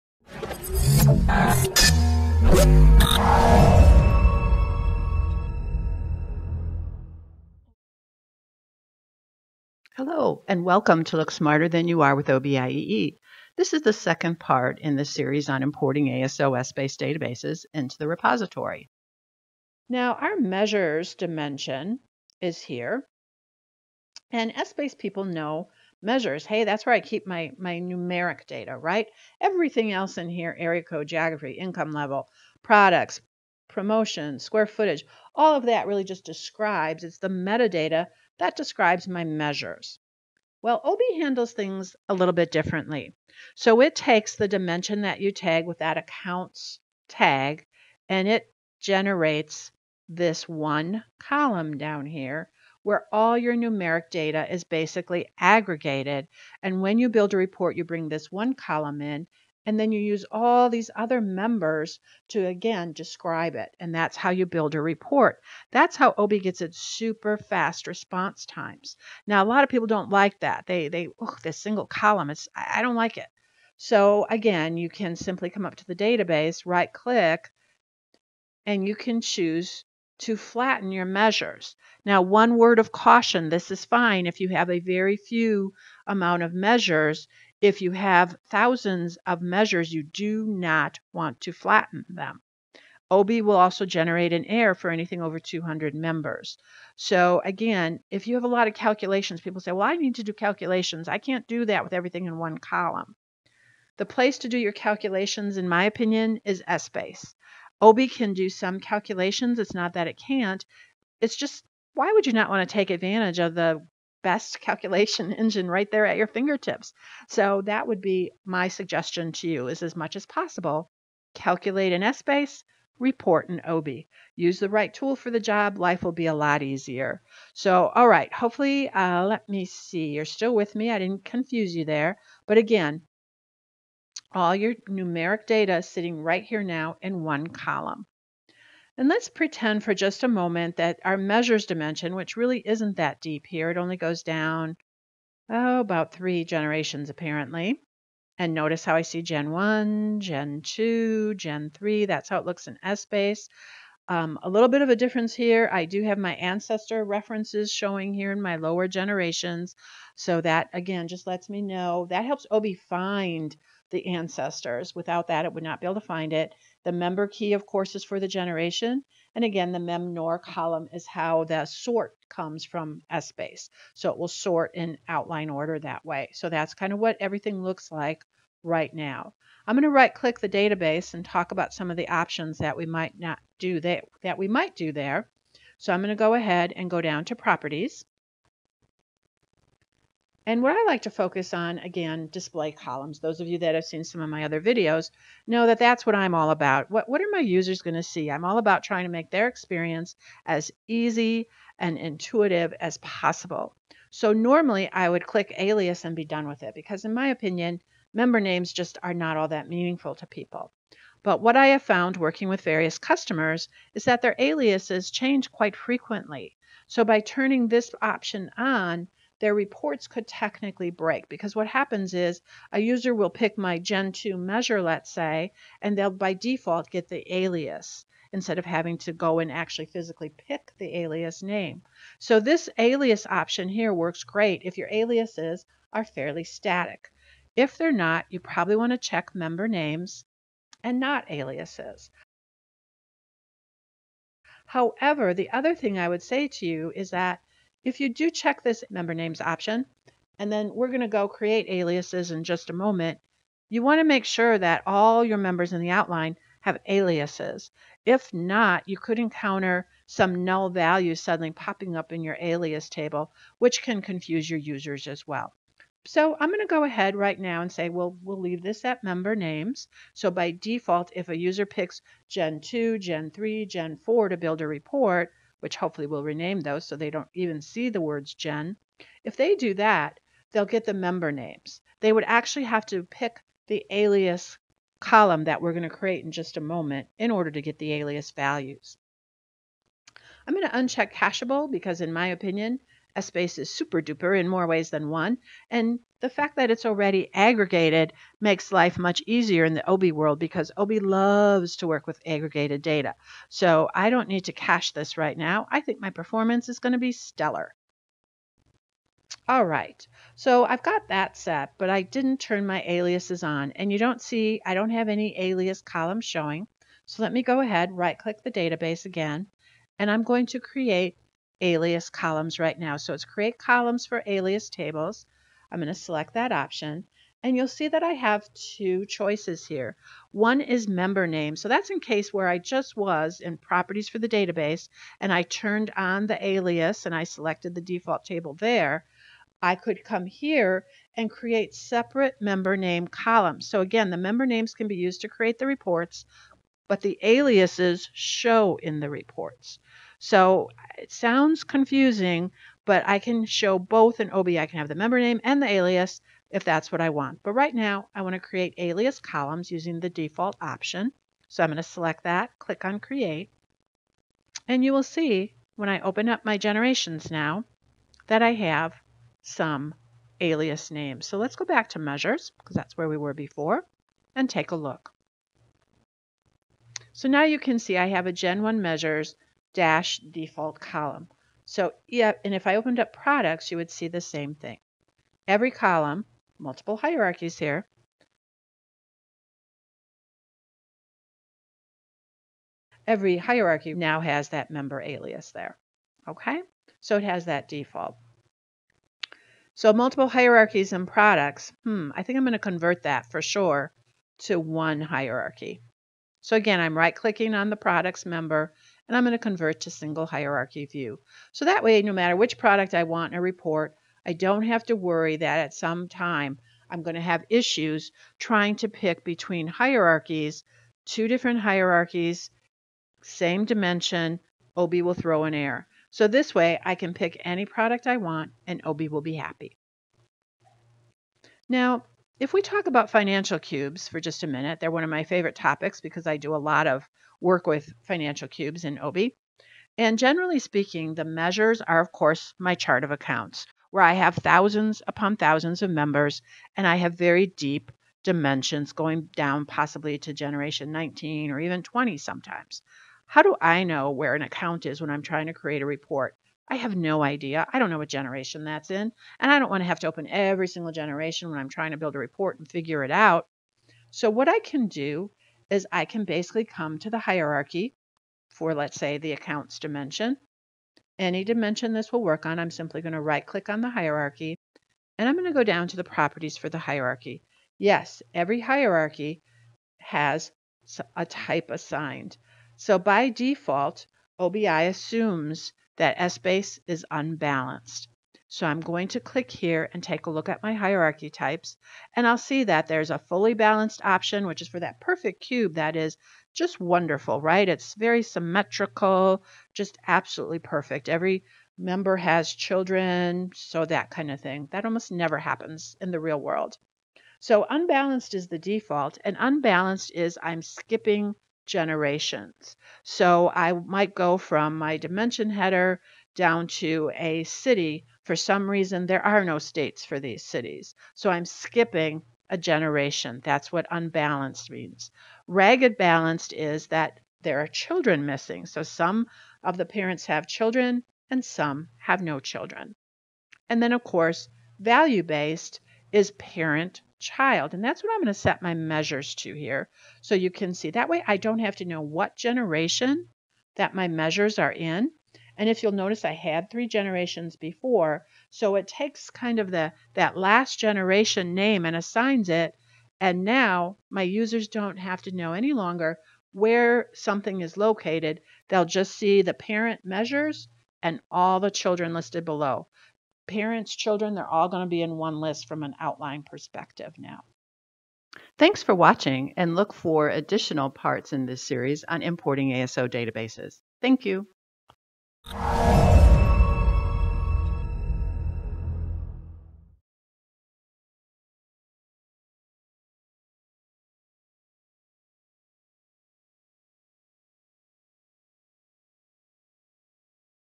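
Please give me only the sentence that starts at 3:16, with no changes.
What, what are my users going to see?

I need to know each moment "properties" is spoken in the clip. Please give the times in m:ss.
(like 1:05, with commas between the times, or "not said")
3:07, 5:33, 7:56.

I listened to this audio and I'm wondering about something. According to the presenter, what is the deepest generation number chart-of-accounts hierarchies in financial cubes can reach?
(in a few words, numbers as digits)
20.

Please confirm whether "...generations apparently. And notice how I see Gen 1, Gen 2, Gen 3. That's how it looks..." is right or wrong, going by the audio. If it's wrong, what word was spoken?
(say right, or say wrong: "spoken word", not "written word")
right.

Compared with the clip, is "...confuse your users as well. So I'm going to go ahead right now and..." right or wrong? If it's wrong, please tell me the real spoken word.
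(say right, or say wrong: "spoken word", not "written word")
right.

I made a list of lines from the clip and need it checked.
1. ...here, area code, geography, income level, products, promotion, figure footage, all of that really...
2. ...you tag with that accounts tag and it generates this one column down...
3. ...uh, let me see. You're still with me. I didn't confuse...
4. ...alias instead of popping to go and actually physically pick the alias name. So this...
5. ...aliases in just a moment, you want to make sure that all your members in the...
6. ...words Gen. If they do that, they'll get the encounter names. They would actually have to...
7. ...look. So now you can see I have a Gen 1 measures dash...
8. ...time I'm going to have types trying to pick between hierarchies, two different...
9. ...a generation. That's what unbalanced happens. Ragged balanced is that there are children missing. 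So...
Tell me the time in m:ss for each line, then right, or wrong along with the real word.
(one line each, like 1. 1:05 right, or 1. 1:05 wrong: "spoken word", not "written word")
1. 0:30 wrong: "square", not "figure"
2. 0:45 right
3. 2:08 right
4. 3:47 wrong: "having", not "popping"
5. 4:11 right
6. 4:38 wrong: "member", not "encounter"
7. 6:14 right
8. 6:56 wrong: "issues", not "types"
9. 8:42 wrong: "means", not "happens".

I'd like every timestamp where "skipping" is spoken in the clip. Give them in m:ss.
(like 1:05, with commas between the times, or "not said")
8:30, 8:41.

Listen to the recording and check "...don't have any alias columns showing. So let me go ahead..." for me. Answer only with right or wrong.
right.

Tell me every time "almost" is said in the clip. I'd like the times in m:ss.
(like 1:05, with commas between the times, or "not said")
8:24.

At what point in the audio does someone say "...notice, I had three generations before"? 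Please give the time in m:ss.
9:05.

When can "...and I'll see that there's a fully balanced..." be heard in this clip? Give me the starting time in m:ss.
8:12.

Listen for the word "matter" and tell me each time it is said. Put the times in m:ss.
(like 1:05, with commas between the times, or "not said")
6:52.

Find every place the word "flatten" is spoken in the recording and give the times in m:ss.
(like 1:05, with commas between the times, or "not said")
1:20, 1:31.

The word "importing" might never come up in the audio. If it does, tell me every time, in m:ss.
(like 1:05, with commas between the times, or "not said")
0:15, 9:32.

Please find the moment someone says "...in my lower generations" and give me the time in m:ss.
2:38.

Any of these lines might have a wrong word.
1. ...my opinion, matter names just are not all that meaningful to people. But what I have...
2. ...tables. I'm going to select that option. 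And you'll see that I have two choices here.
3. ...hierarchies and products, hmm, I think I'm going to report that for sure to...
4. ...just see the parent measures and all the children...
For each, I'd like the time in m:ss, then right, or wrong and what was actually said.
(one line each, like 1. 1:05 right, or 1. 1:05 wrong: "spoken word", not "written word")
1. 3:27 wrong: "member", not "matter"
2. 5:24 right
3. 6:40 wrong: "convert", not "report"
4. 9:18 right.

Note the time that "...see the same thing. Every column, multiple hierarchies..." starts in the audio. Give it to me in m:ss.
6:23.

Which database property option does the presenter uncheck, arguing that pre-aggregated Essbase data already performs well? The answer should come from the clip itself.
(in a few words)
cacheable.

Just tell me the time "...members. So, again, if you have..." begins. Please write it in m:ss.
1:35.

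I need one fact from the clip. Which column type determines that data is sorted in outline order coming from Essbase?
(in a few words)
memnor column.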